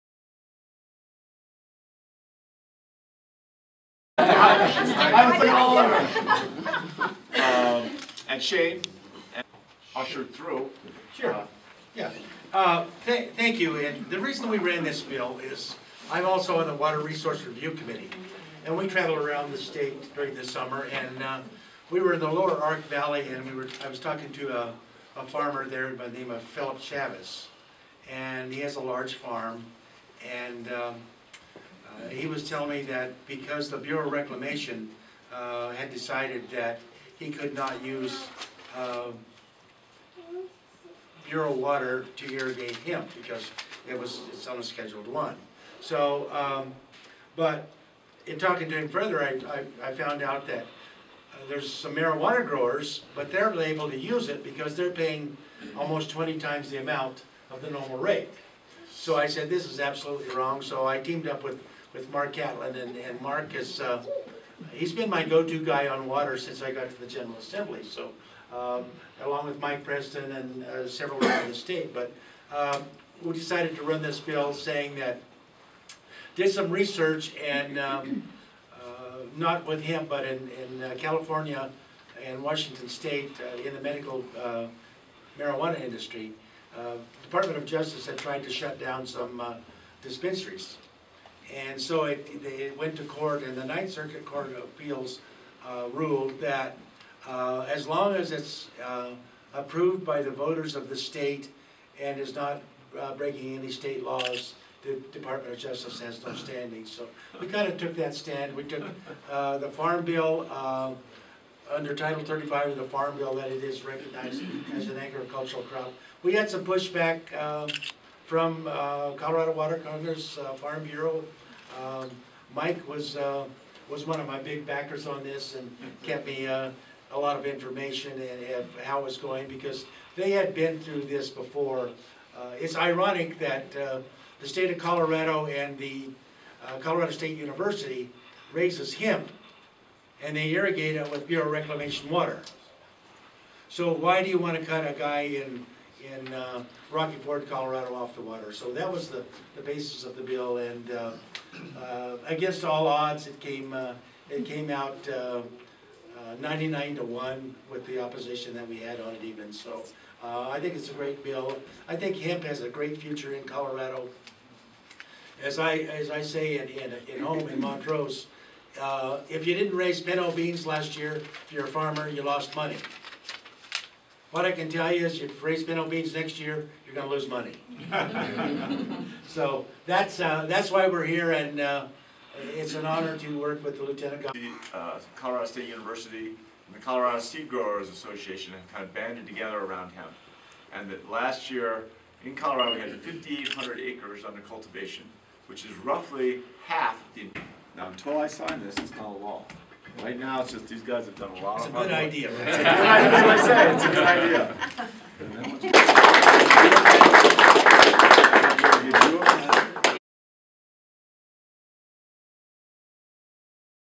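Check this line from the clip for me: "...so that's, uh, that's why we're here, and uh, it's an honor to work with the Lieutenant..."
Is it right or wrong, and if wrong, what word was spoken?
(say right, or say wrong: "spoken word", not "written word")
right.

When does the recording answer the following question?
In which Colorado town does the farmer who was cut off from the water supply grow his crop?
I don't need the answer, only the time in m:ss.
2:26.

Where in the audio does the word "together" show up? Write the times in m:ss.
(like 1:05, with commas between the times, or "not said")
3:09.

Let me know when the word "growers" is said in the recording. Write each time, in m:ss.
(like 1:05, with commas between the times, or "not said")
0:52, 3:07.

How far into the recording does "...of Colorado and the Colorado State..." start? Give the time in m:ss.
2:14.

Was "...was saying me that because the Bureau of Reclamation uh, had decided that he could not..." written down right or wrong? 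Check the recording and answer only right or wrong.
wrong.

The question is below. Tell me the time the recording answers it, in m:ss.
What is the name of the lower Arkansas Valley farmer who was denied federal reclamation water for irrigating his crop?
0:26.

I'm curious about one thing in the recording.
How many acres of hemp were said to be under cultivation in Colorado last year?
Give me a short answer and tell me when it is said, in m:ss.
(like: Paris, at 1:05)
5,800, at 3:13.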